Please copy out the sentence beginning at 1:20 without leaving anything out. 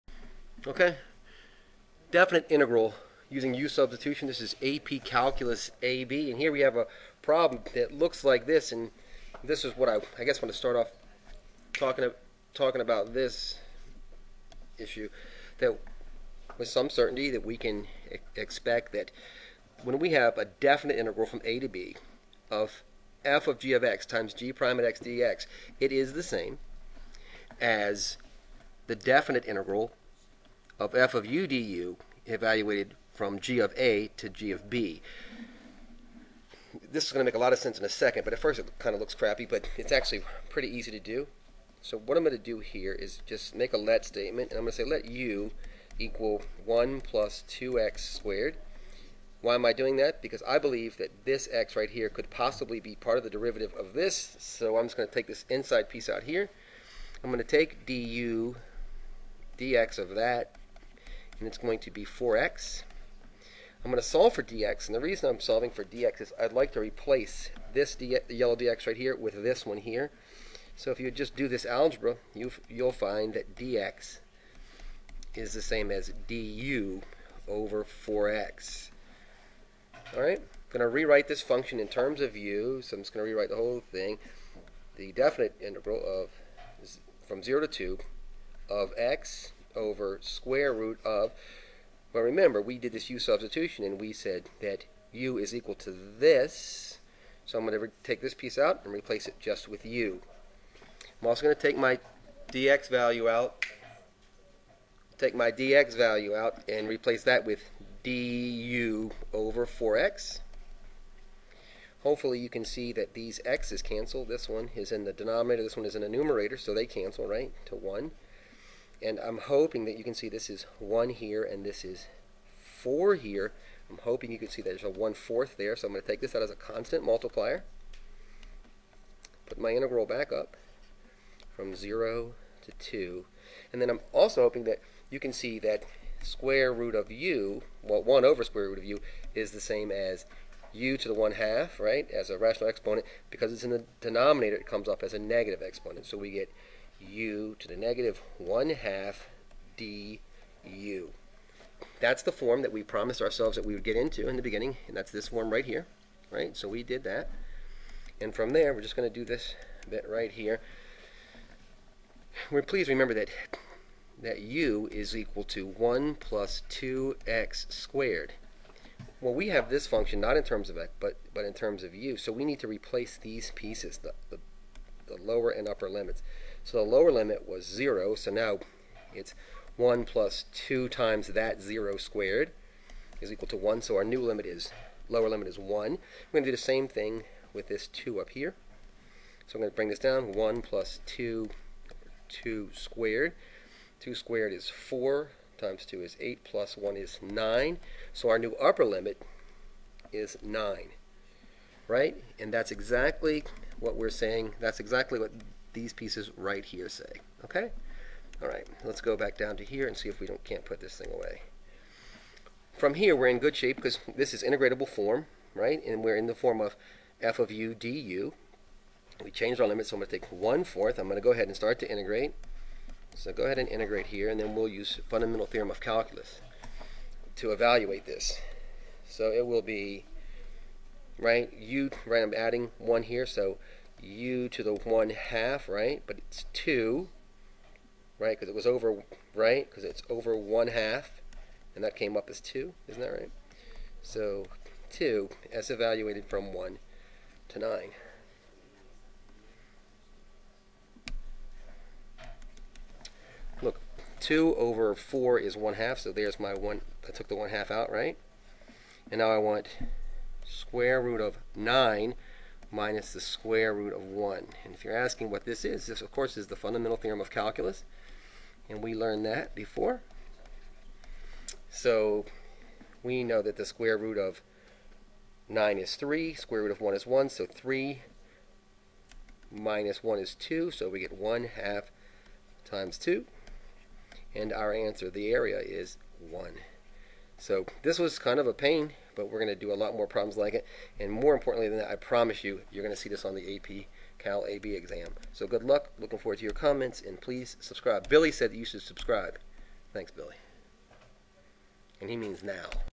All right, I'm going to rewrite this function in terms of u, so I'm just going to rewrite the whole thing.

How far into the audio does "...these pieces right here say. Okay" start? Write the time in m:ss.
3:25.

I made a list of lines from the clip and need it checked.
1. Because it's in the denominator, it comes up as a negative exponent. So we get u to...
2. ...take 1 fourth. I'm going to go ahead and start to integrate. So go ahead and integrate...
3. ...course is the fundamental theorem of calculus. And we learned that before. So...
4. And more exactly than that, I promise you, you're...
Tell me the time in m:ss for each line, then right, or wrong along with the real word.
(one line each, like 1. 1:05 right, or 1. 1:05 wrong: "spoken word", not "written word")
1. 2:23 right
2. 3:40 right
3. 4:26 right
4. 4:50 wrong: "importantly", not "exactly".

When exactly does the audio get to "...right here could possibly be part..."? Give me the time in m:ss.
0:51.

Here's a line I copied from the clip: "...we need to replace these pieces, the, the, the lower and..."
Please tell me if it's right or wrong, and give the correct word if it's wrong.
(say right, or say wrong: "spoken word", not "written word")
right.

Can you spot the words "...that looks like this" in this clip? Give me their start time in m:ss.
0:07.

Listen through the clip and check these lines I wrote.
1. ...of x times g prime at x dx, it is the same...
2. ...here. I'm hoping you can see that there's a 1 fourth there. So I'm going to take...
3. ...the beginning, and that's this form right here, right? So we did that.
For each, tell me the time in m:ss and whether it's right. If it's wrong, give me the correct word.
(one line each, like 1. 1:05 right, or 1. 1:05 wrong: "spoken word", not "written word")
1. 0:23 right
2. 2:03 right
3. 2:34 right.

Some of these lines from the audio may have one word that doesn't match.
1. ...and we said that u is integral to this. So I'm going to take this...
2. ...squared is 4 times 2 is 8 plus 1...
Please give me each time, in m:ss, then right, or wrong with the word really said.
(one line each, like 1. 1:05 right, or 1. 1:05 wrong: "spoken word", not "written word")
1. 1:33 wrong: "equal", not "integral"
2. 3:14 right.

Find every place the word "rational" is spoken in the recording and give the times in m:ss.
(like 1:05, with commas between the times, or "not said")
2:22.